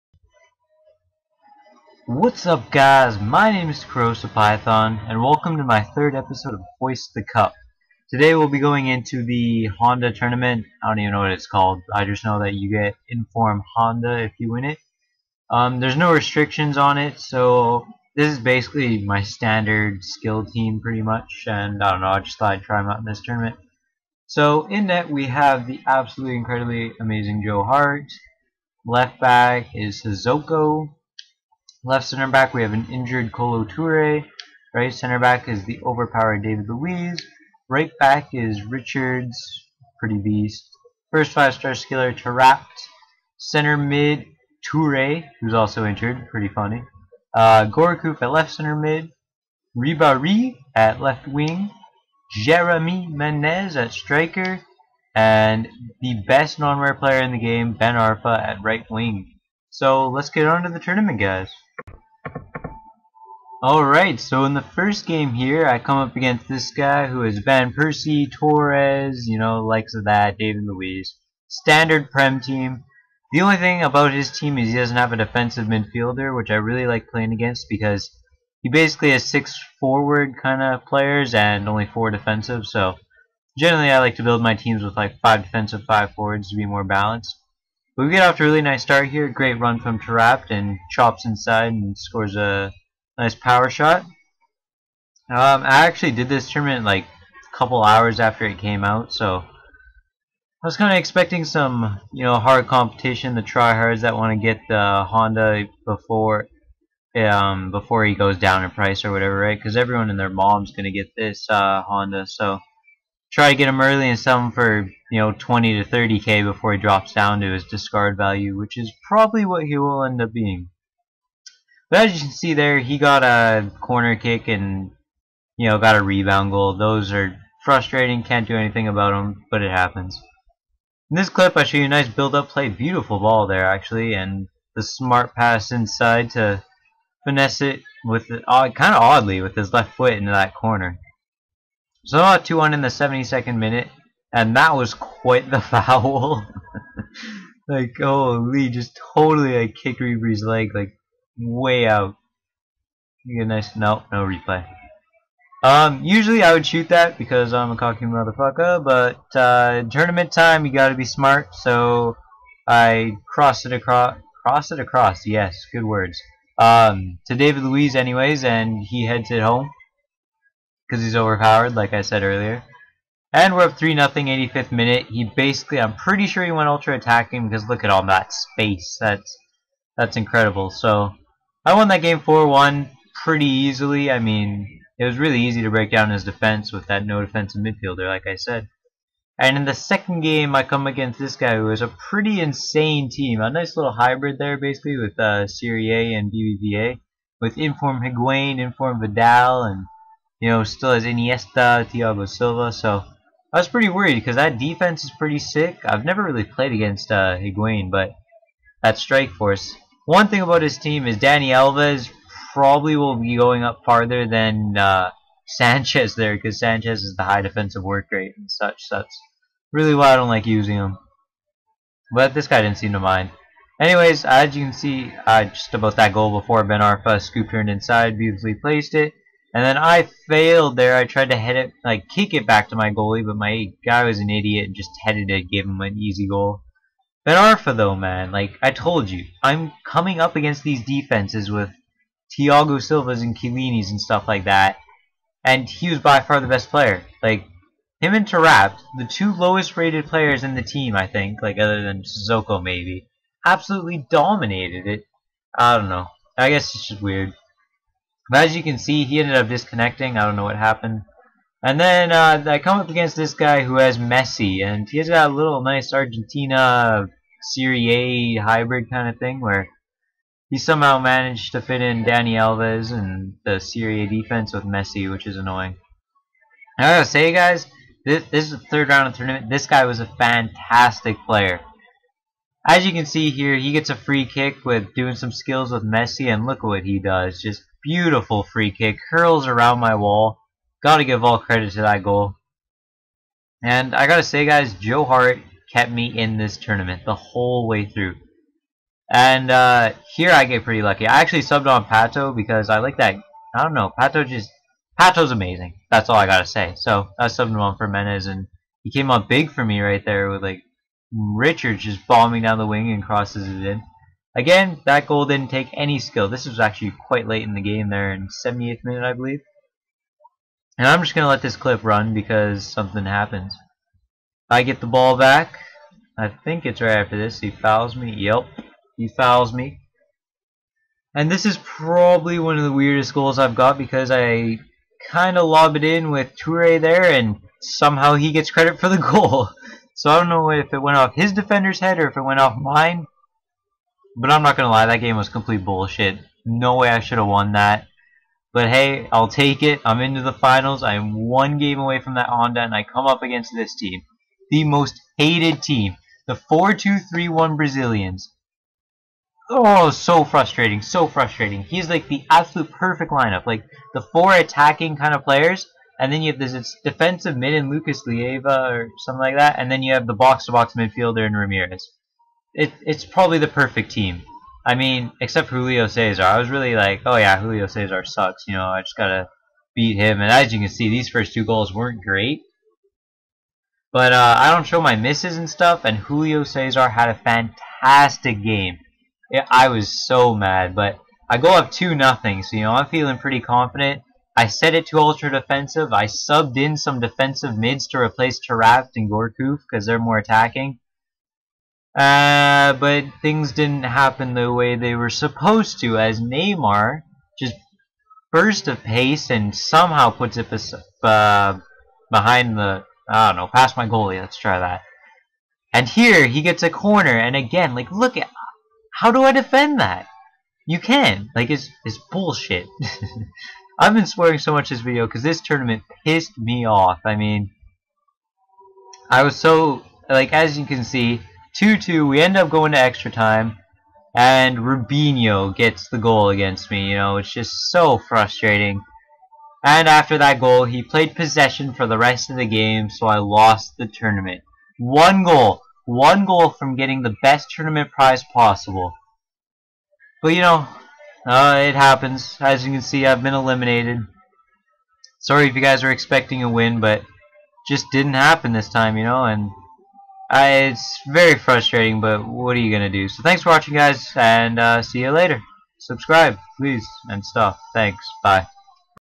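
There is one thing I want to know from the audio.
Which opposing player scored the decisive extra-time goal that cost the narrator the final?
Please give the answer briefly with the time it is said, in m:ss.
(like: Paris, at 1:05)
Robinho, at 7:14.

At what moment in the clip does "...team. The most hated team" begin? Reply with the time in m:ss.
5:53.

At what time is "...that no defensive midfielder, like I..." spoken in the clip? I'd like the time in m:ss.
3:06.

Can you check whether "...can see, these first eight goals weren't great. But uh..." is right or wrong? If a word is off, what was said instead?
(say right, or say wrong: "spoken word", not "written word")
wrong: "two", not "eight".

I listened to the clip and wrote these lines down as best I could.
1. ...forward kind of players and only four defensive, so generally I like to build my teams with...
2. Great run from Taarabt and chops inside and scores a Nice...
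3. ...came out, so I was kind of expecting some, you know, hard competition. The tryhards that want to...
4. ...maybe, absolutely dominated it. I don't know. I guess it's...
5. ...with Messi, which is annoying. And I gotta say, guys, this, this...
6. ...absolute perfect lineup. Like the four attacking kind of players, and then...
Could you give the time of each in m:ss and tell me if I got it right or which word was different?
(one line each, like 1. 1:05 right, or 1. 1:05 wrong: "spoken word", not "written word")
1. 1:19 right
2. 1:29 right
3. 1:38 right
4. 4:12 right
5. 4:34 right
6. 6:02 right.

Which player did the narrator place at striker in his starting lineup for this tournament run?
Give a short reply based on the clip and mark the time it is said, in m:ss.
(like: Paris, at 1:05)
Jeremy Menez, at 0:52.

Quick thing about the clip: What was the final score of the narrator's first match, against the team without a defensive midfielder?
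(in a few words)
4-1.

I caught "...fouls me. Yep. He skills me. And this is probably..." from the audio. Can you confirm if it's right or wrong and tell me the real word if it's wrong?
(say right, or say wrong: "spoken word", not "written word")
wrong: "fouls", not "skills".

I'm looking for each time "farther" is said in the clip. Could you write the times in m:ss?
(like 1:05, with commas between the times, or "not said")
3:33.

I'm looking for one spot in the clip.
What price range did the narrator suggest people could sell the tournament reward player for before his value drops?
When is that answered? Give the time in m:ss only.
1:55.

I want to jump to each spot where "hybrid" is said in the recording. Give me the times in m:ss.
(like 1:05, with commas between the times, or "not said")
3:13, 4:28.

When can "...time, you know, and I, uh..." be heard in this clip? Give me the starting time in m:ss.
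7:38.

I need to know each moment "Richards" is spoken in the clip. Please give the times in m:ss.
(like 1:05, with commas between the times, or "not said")
0:38, 5:11.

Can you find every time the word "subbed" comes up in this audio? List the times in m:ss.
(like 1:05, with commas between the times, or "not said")
5:01, 5:07, 6:36.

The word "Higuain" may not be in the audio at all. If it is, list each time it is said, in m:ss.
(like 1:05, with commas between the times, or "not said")
3:18, 3:27.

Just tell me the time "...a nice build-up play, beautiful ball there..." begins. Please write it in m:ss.
2:11.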